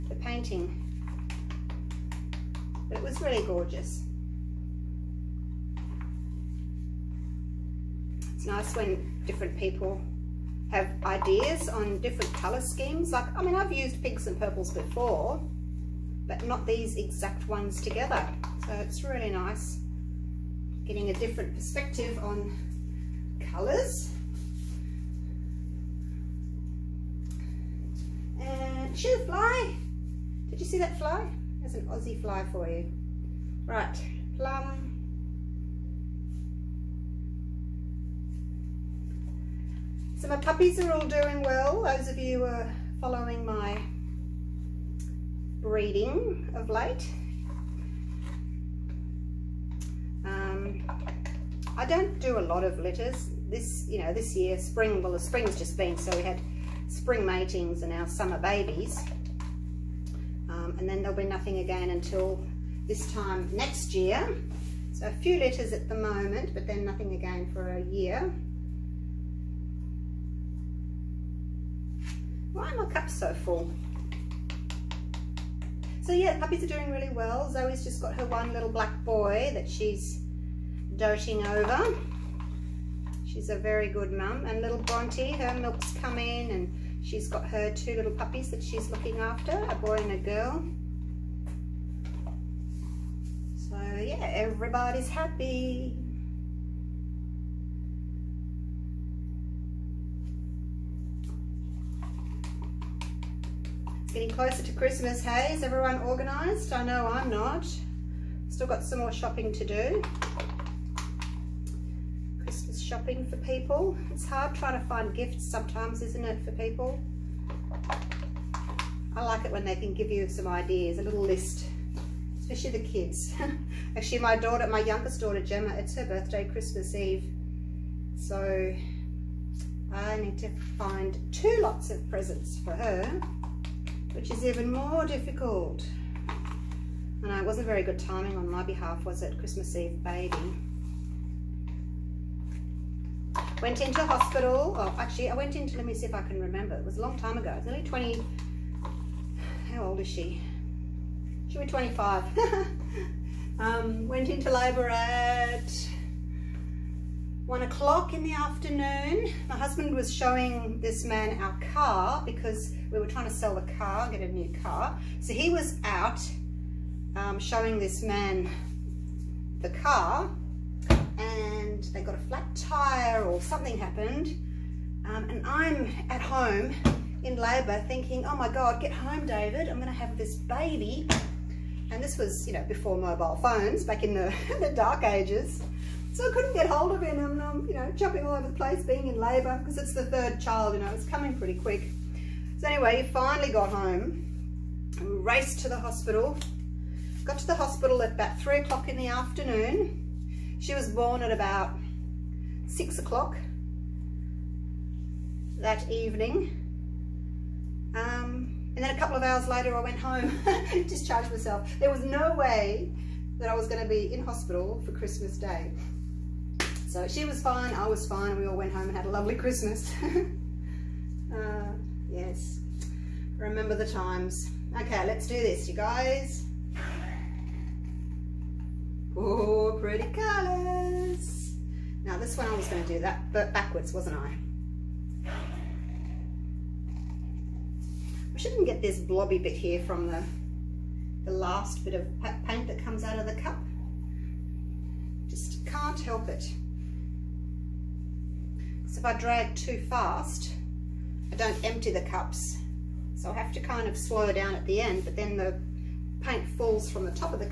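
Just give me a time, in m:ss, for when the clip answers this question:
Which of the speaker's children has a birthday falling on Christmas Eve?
2:05.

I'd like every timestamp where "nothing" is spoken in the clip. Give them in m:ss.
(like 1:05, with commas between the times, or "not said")
1:01, 1:06.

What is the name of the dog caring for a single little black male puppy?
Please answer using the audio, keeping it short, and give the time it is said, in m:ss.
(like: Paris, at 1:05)
Zoe, at 1:17.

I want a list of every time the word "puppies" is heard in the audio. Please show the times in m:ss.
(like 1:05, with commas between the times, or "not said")
0:40, 1:16, 1:28.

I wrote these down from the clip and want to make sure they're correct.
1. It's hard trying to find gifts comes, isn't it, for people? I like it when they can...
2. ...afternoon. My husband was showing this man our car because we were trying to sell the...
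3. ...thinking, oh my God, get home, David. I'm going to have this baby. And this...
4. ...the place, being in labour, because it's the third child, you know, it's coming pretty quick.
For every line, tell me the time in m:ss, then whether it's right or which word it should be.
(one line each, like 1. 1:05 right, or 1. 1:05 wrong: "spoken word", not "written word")
1. 1:54 wrong: "sometimes", not "comes"
2. 2:38 right
3. 2:57 right
4. 3:08 right.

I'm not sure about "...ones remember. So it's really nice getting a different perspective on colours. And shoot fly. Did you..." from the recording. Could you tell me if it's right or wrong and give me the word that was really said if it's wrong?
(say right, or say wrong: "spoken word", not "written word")
wrong: "together", not "remember".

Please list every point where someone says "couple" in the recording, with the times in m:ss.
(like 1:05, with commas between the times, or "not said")
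3:28.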